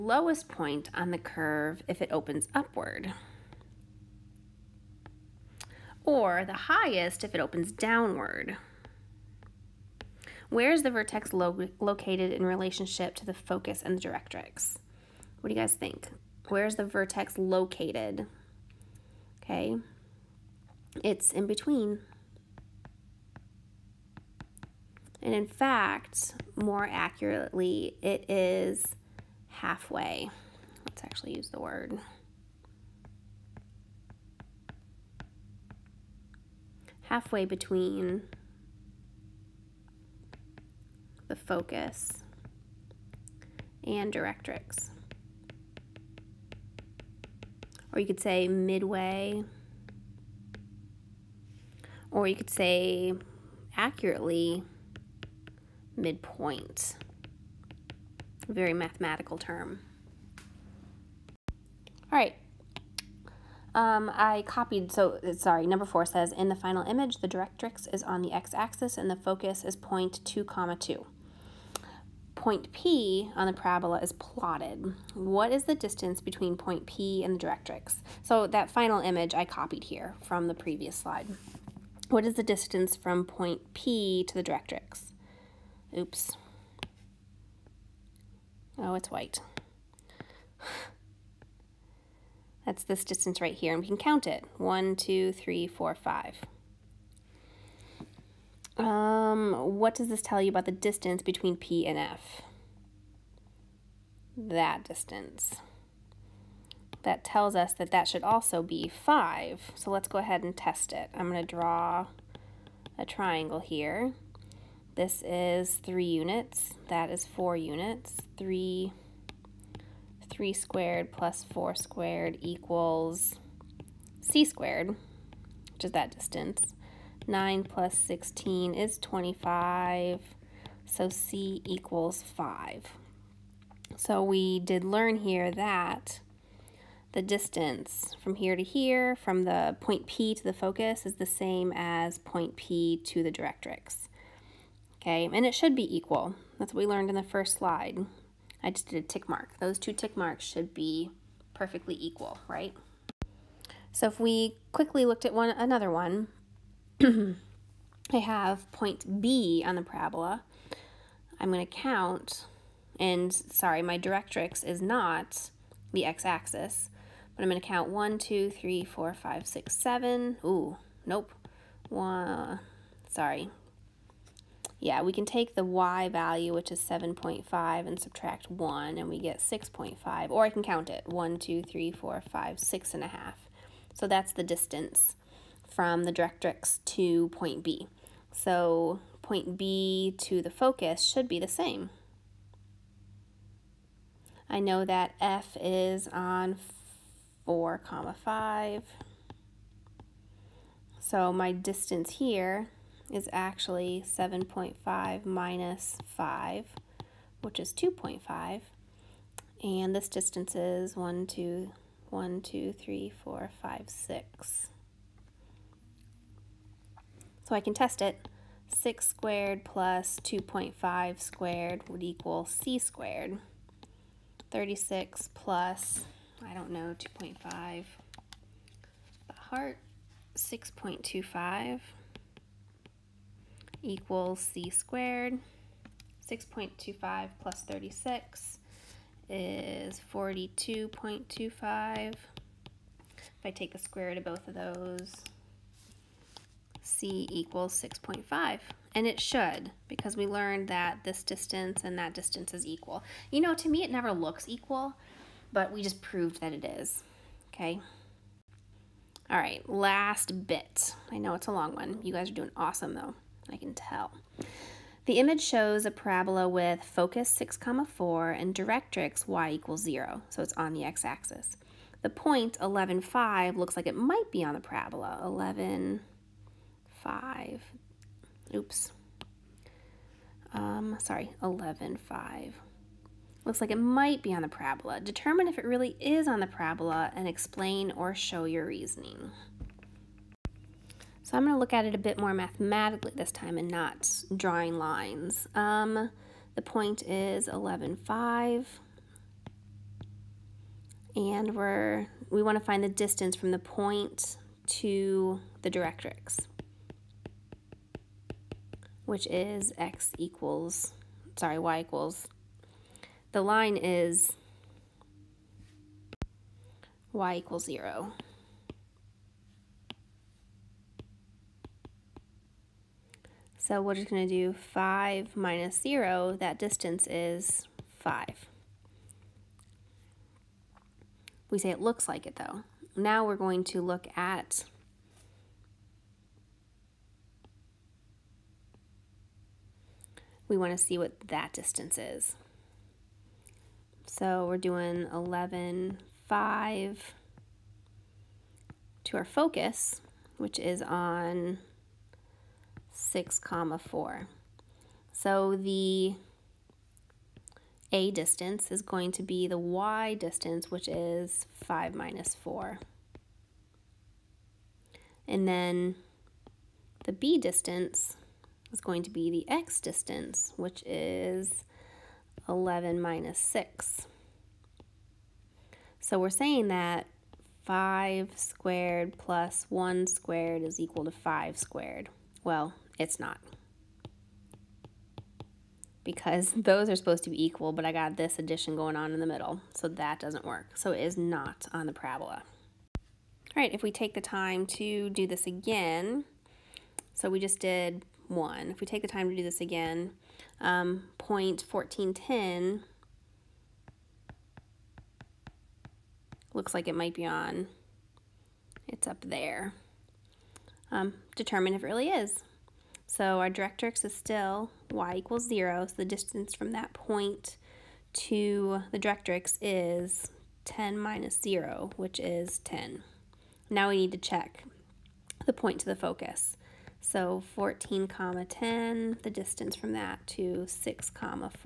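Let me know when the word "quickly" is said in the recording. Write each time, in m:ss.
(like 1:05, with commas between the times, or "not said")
2:34.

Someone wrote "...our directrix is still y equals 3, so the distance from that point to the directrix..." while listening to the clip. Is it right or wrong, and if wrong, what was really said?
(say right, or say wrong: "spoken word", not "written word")
wrong: "0", not "3".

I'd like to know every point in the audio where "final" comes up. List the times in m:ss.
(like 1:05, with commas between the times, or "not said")
1:06, 1:18.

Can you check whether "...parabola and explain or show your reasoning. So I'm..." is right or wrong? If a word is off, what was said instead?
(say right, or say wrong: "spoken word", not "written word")
right.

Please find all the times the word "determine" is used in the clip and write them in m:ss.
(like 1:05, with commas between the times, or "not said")
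4:44, 6:51.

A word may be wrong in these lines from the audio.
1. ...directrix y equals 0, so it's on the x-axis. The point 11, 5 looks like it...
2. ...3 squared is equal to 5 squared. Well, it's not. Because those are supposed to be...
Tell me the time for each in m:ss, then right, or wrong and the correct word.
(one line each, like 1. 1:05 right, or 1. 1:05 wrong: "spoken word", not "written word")
1. 4:28 right
2. 6:19 wrong: "1", not "3".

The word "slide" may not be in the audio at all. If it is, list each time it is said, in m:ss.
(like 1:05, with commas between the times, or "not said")
1:20, 2:27.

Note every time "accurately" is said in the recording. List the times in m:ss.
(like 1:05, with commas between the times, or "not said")
0:26, 0:53.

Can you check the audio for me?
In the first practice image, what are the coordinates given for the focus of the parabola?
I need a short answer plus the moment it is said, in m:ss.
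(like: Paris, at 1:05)
(2, 2), at 1:09.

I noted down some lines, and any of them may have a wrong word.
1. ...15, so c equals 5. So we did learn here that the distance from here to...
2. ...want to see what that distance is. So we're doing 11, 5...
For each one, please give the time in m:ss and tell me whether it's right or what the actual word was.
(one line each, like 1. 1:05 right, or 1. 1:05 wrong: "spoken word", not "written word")
1. 2:08 wrong: "25", not "15"
2. 5:40 right.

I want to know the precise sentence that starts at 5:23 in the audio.
So we're just going to do 5 minus 0.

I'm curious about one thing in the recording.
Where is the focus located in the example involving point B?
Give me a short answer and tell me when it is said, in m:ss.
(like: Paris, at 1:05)
(4, 5), at 3:17.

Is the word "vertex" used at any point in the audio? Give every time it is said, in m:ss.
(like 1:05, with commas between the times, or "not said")
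0:10, 0:16.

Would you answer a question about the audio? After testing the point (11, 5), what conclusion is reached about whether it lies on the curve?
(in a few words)
not on the parabola.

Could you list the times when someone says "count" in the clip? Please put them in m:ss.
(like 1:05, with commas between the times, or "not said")
1:33, 2:41, 2:47, 3:00.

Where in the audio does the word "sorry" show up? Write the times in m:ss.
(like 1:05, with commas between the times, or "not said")
1:05, 2:43, 2:53, 4:40, 5:11.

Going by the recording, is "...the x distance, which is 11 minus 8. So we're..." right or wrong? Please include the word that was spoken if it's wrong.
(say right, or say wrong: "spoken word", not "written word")
wrong: "6", not "8".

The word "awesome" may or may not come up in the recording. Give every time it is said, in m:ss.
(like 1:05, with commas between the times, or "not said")
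4:22.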